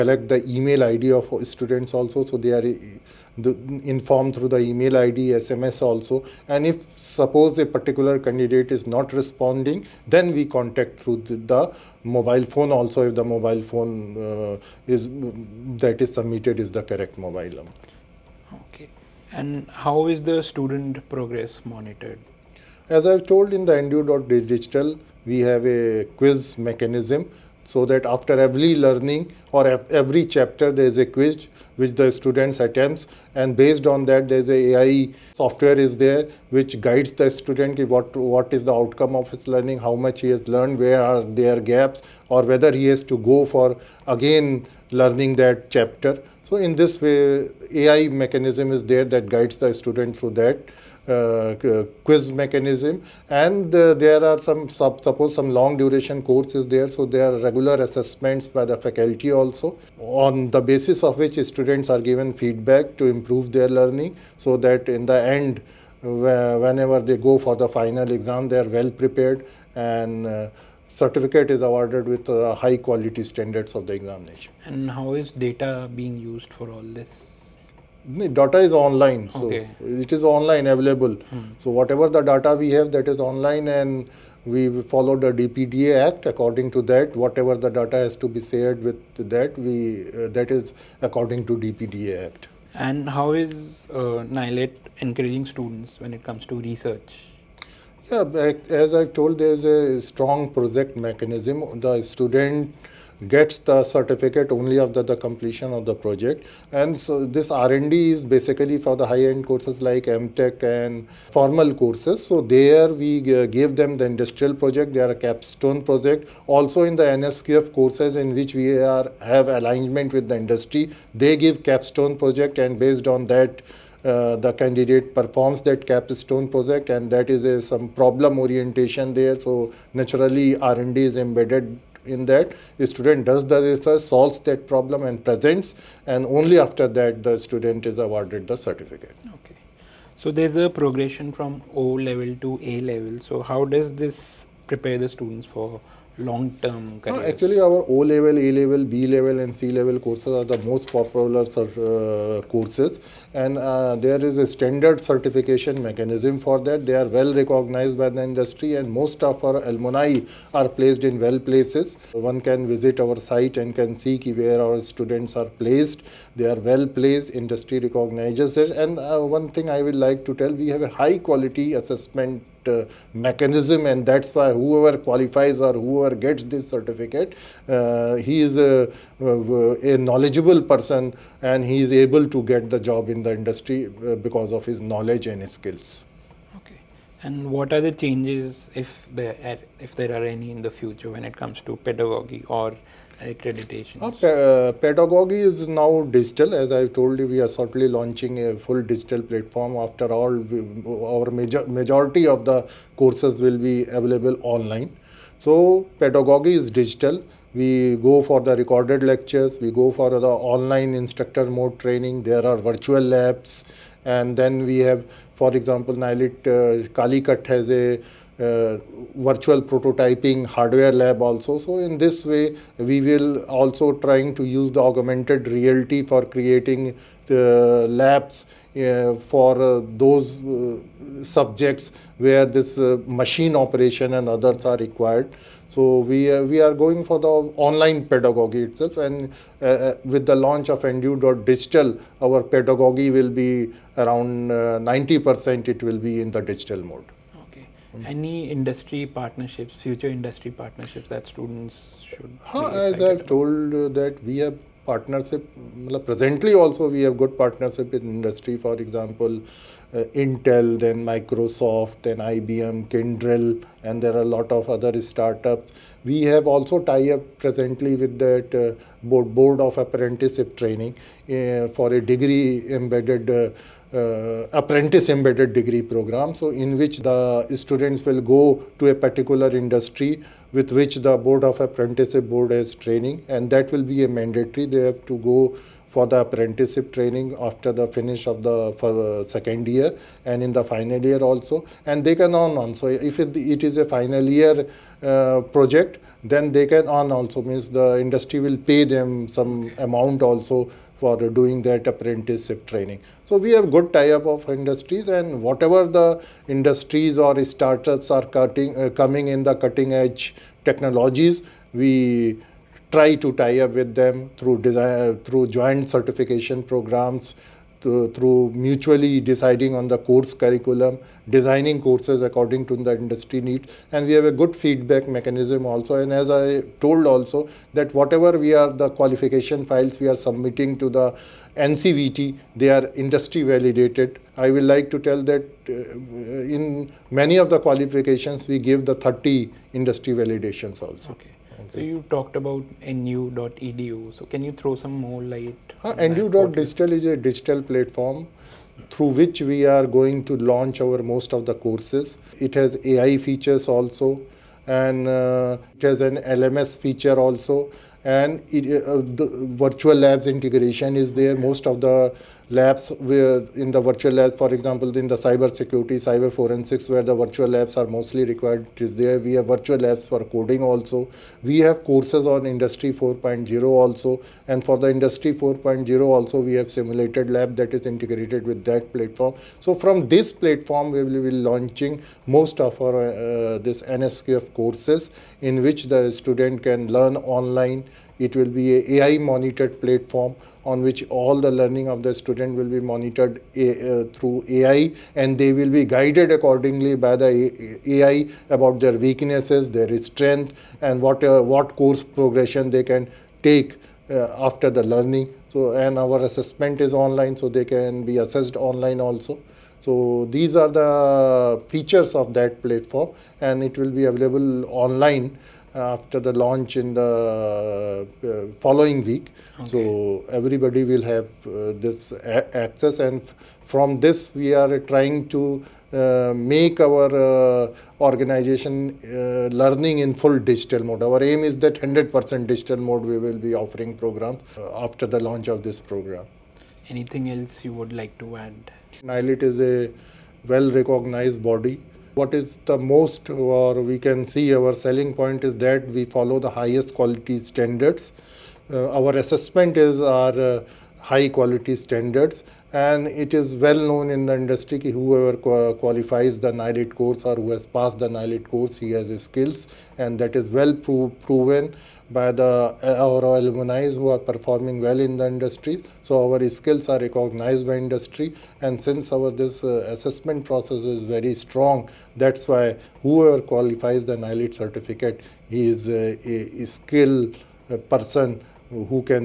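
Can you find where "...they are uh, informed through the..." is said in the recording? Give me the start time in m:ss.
0:02.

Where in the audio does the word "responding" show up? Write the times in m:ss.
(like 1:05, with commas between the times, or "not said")
0:09.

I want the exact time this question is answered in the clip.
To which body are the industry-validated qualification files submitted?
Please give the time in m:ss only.
5:31.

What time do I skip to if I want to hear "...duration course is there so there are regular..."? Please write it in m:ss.
0:55.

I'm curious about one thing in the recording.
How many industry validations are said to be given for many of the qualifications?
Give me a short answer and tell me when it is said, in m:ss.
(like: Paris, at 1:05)
30, at 5:38.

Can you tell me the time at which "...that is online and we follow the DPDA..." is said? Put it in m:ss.
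1:22.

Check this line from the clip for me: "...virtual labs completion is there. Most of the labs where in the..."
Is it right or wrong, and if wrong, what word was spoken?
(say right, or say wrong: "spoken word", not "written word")
wrong: "integration", not "completion".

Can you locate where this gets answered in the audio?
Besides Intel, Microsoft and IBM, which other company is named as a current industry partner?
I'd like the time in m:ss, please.
4:22.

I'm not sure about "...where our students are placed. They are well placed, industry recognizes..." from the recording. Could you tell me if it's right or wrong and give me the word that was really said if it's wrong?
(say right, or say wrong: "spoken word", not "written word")
right.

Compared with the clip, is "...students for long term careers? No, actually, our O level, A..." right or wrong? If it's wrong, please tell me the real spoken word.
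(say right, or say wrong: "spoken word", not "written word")
right.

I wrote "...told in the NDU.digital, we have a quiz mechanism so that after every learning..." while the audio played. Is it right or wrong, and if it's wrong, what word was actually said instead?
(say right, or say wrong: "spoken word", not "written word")
right.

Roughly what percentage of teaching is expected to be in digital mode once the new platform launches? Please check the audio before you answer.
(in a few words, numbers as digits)
90%.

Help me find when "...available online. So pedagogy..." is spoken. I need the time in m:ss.
3:23.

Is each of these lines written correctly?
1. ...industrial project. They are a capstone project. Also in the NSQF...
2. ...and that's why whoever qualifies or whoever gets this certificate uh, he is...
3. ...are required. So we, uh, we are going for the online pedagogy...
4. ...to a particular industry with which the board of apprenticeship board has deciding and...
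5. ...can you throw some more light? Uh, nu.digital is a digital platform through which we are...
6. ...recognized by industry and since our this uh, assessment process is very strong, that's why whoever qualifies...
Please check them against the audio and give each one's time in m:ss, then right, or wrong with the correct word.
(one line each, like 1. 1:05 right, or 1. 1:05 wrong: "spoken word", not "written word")
1. 1:54 right
2. 2:53 right
3. 3:54 right
4. 4:38 wrong: "training", not "deciding"
5. 5:44 right
6. 7:46 right.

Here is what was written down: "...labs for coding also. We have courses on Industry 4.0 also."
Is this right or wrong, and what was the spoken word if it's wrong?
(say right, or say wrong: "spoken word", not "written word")
right.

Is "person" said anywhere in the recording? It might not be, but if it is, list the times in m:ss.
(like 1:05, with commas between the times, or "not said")
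3:00, 7:57.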